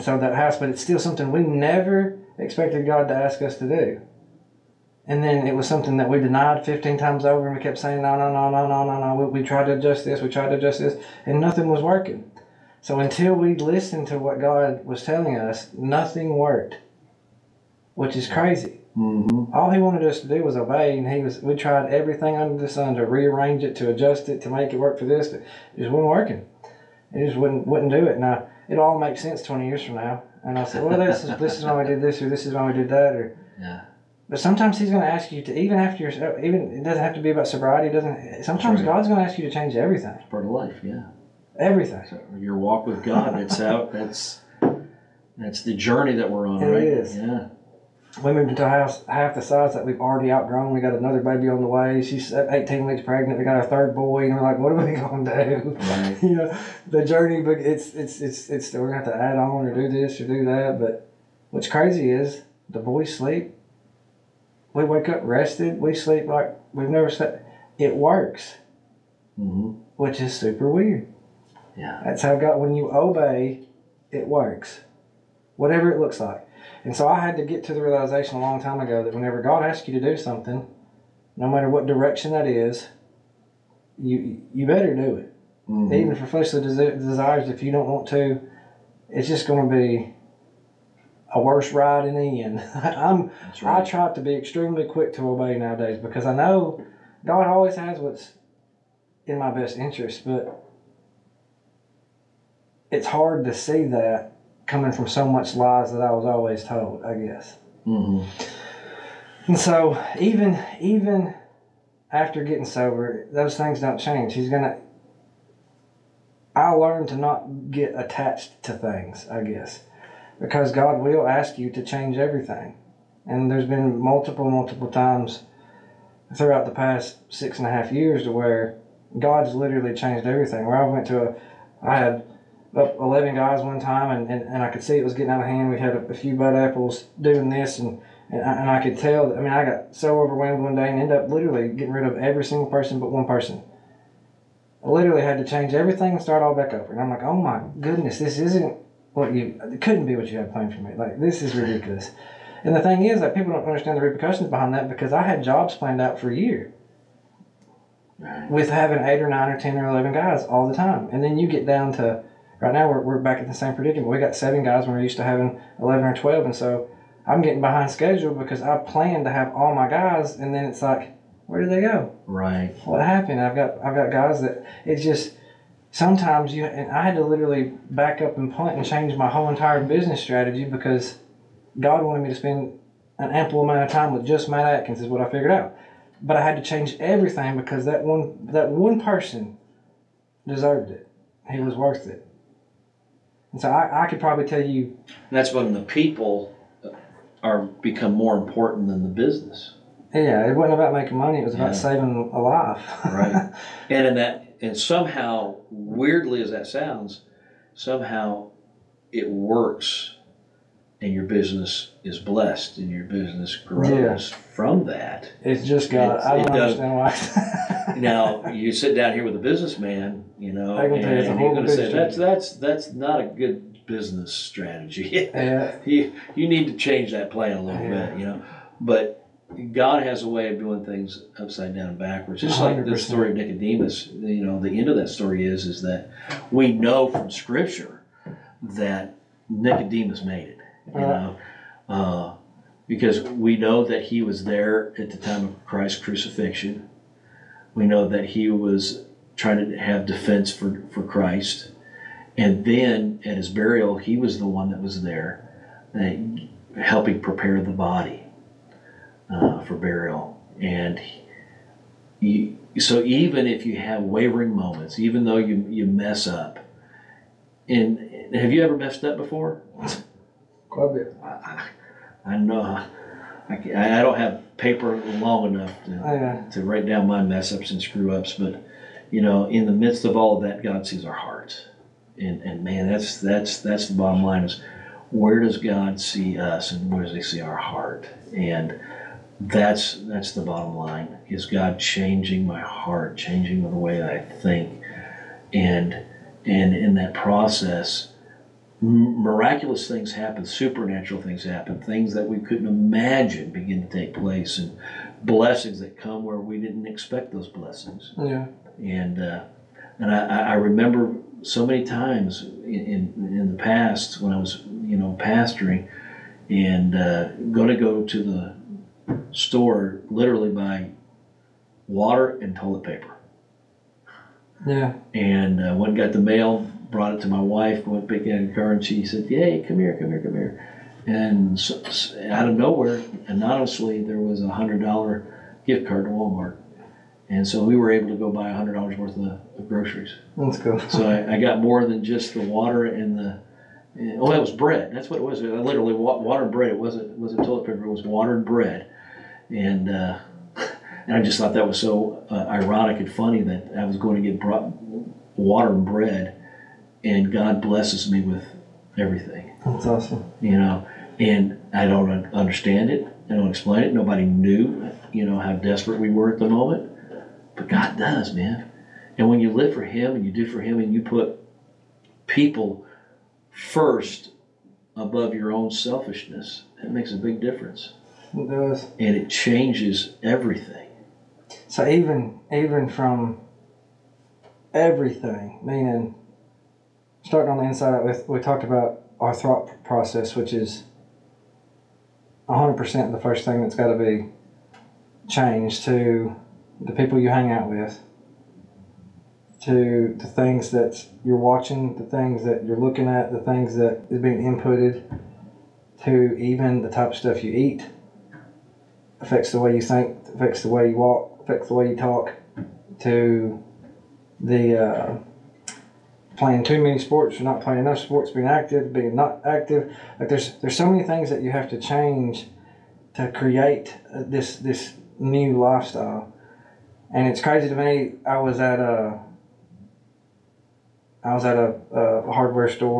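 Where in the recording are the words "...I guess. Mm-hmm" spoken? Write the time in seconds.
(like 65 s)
107 s.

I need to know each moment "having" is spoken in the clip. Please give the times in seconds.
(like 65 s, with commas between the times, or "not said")
158 s, 165 s.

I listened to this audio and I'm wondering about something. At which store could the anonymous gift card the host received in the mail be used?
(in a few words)
Walmart.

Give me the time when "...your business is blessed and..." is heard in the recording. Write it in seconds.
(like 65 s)
211 s.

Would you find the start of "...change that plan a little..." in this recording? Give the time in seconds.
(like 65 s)
226 s.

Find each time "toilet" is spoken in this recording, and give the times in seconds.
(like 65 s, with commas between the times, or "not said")
322 s, 347 s.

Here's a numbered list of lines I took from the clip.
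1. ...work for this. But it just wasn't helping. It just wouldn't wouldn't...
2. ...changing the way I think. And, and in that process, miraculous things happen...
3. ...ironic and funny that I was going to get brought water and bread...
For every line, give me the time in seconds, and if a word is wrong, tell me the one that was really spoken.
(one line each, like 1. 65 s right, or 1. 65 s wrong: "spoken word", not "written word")
1. 24 s wrong: "working", not "helping"
2. 293 s right
3. 352 s right.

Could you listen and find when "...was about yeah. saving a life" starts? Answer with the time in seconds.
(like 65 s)
201 s.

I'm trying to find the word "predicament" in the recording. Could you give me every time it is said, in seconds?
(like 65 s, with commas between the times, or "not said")
163 s.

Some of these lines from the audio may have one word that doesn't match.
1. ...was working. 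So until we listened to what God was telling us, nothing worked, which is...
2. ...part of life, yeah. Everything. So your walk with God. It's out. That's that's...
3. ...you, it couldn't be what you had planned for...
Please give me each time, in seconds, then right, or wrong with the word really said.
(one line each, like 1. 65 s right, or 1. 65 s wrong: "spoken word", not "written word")
1. 11 s right
2. 40 s right
3. 149 s right.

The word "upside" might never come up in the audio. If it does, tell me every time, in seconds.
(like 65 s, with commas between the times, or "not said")
231 s.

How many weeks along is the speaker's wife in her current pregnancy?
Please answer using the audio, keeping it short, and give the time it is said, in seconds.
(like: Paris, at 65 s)
18, at 52 s.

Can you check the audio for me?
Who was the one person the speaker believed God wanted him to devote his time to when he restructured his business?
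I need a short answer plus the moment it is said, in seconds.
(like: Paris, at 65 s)
Matt Atkins, at 184 s.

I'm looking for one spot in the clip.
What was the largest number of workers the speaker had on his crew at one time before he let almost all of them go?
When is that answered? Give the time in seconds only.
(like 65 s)
132 s.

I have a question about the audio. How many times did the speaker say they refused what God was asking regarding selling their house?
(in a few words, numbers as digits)
15.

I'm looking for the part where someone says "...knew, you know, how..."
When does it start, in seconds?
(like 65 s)
364 s.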